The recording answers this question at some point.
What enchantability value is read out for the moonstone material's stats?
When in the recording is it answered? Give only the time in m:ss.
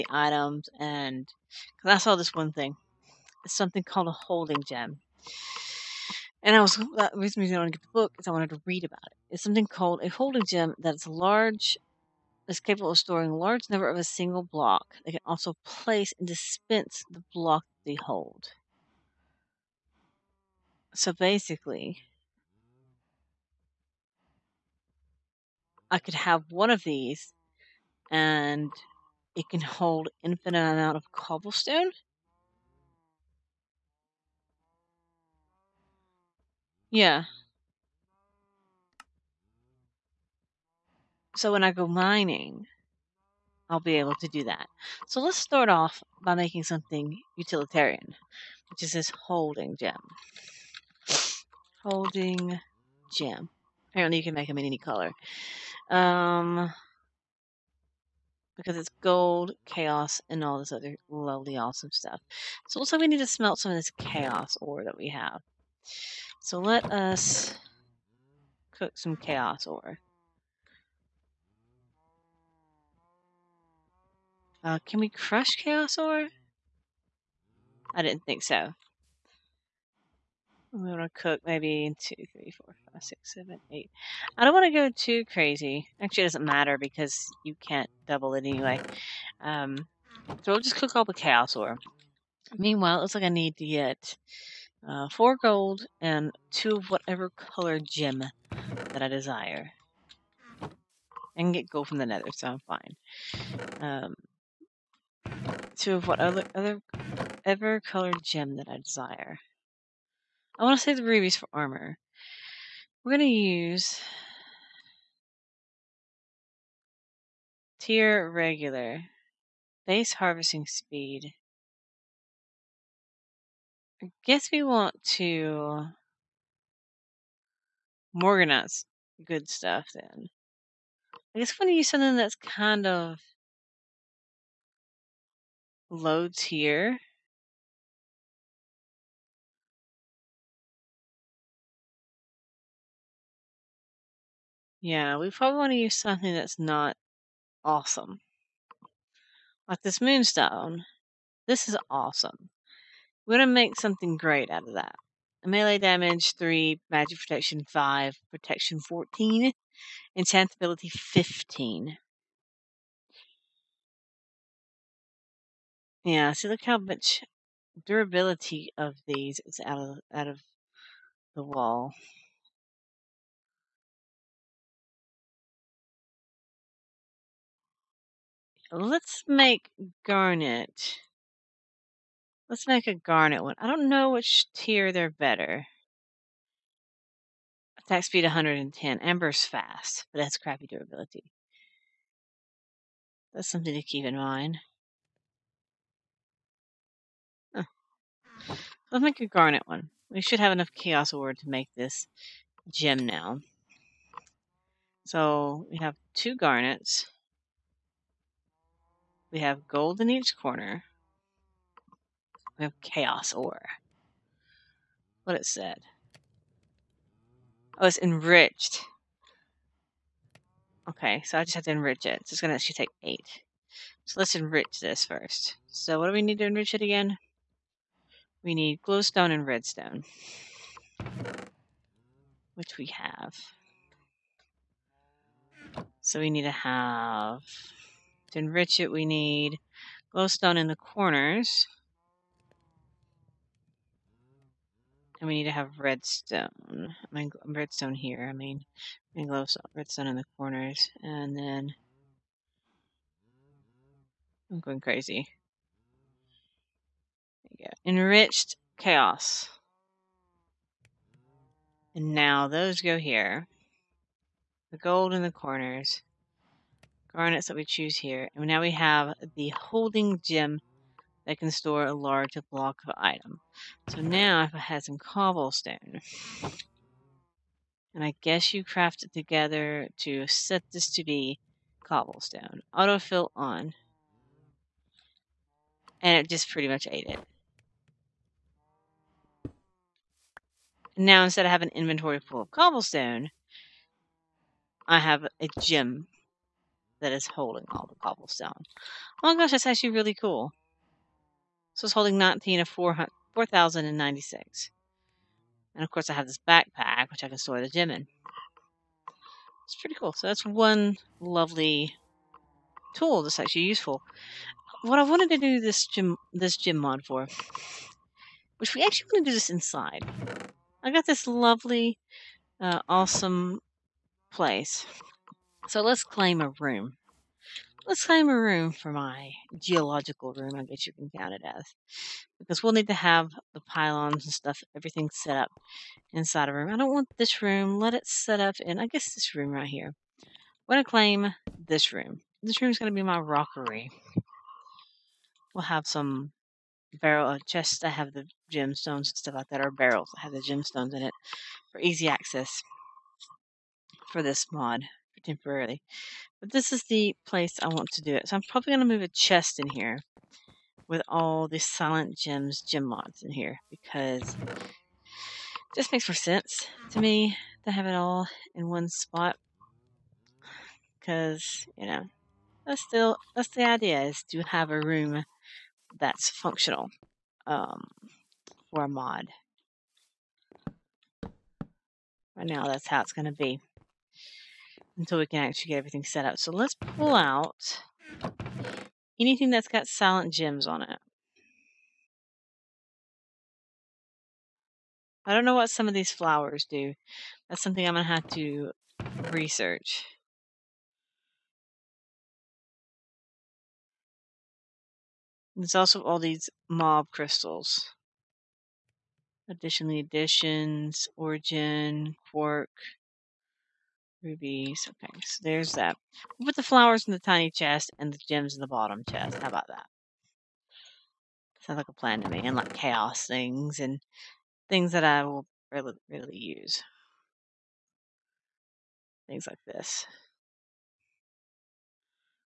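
2:40.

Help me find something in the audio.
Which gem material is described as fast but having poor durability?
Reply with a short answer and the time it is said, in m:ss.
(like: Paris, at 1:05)
Amber, at 3:08.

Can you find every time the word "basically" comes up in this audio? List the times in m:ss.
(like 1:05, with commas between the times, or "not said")
0:21.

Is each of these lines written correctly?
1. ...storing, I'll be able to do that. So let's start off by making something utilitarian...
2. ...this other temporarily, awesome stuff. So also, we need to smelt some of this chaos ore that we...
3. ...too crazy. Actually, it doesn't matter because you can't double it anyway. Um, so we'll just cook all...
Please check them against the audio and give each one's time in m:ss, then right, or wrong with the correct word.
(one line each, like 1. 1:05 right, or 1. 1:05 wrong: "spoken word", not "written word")
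1. 0:41 wrong: "mining", not "storing"
2. 1:00 wrong: "lovely", not "temporarily"
3. 1:24 right.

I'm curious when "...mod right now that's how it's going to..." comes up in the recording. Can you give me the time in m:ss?
6:18.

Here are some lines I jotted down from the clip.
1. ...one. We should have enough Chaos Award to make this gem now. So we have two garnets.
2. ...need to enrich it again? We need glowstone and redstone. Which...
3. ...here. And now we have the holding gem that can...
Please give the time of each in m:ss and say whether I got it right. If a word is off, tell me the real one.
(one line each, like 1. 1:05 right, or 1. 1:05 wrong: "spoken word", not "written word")
1. 3:19 right
2. 3:46 right
3. 4:27 right.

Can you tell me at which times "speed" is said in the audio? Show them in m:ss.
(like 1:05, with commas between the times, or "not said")
2:00, 3:08.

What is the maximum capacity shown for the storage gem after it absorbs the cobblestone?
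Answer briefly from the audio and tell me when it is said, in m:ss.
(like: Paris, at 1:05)
4,096, at 5:02.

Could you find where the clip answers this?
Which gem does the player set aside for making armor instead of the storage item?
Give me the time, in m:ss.
1:51.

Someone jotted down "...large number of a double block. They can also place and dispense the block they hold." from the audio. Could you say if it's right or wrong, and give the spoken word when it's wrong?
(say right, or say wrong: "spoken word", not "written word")
wrong: "single", not "double".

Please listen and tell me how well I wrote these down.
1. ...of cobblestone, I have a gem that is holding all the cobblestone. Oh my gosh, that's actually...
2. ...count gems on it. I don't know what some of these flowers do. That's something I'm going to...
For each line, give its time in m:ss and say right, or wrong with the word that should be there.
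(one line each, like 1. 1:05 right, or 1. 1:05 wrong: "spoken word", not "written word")
1. 4:52 right
2. 6:29 wrong: "silent", not "count".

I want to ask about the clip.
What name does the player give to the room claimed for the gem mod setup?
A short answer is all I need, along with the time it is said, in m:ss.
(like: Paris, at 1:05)
Rockery, at 5:43.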